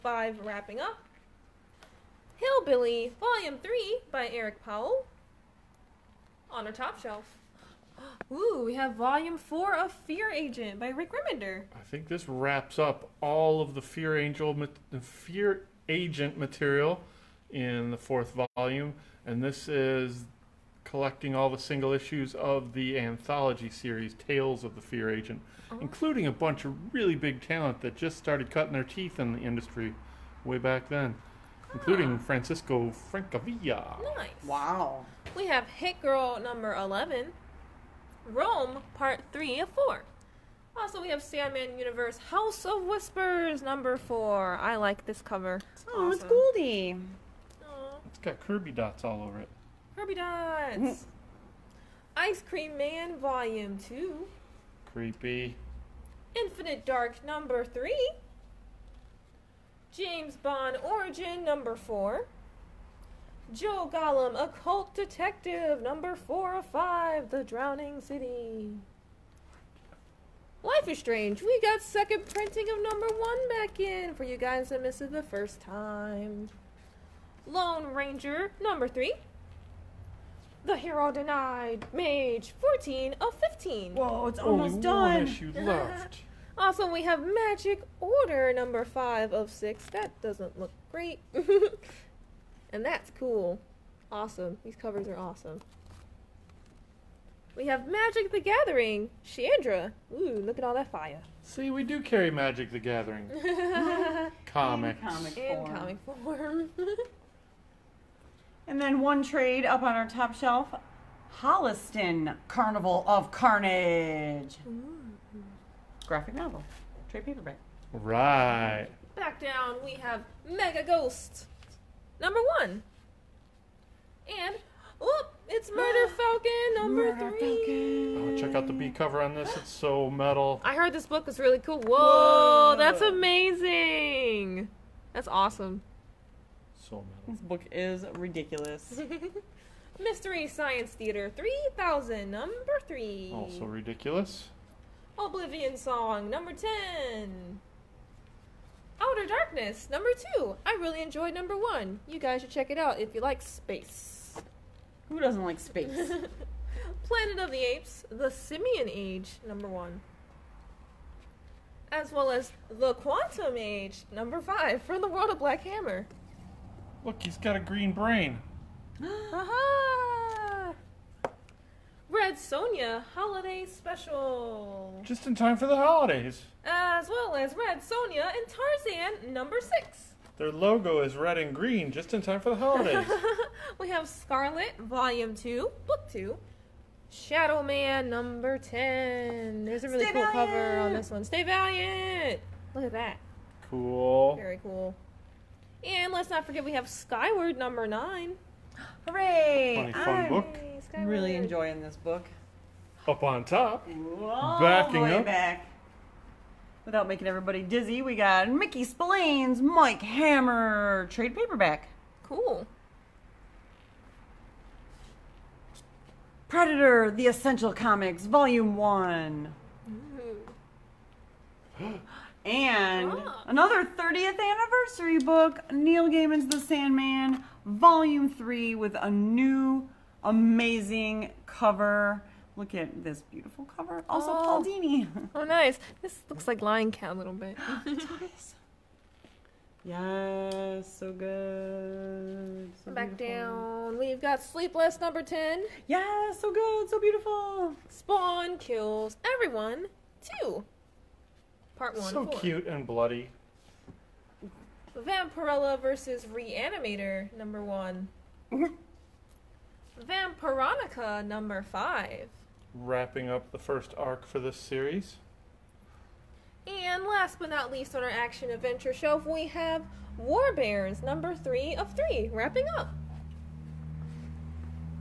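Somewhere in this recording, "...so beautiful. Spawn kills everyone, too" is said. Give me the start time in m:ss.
4:06.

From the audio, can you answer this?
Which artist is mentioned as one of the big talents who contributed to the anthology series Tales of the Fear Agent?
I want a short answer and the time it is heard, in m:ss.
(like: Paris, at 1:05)
Francesco Francavilla, at 0:32.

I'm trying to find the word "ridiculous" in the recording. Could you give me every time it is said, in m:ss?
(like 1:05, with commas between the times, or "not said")
2:18, 2:23.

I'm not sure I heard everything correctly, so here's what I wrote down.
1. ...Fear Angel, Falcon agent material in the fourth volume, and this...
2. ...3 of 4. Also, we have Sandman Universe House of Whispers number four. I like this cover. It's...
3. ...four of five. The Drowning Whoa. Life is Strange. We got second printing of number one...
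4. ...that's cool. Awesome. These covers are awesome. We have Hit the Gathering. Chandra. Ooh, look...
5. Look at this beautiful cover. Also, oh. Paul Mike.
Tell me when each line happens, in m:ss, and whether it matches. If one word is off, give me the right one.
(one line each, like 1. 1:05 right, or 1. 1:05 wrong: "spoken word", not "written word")
1. 0:13 wrong: "Fear", not "Falcon"
2. 0:39 right
3. 1:06 wrong: "City", not "Whoa"
4. 1:32 wrong: "Magic", not "Hit"
5. 3:52 wrong: "Dini", not "Mike".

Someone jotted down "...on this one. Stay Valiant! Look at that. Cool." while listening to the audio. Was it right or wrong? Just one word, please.
right.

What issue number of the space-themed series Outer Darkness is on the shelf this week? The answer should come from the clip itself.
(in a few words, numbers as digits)
2.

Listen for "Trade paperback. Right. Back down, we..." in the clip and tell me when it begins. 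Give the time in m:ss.
1:57.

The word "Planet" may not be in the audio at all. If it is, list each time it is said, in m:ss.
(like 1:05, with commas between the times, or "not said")
2:37.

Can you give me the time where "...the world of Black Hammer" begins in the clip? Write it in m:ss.
2:45.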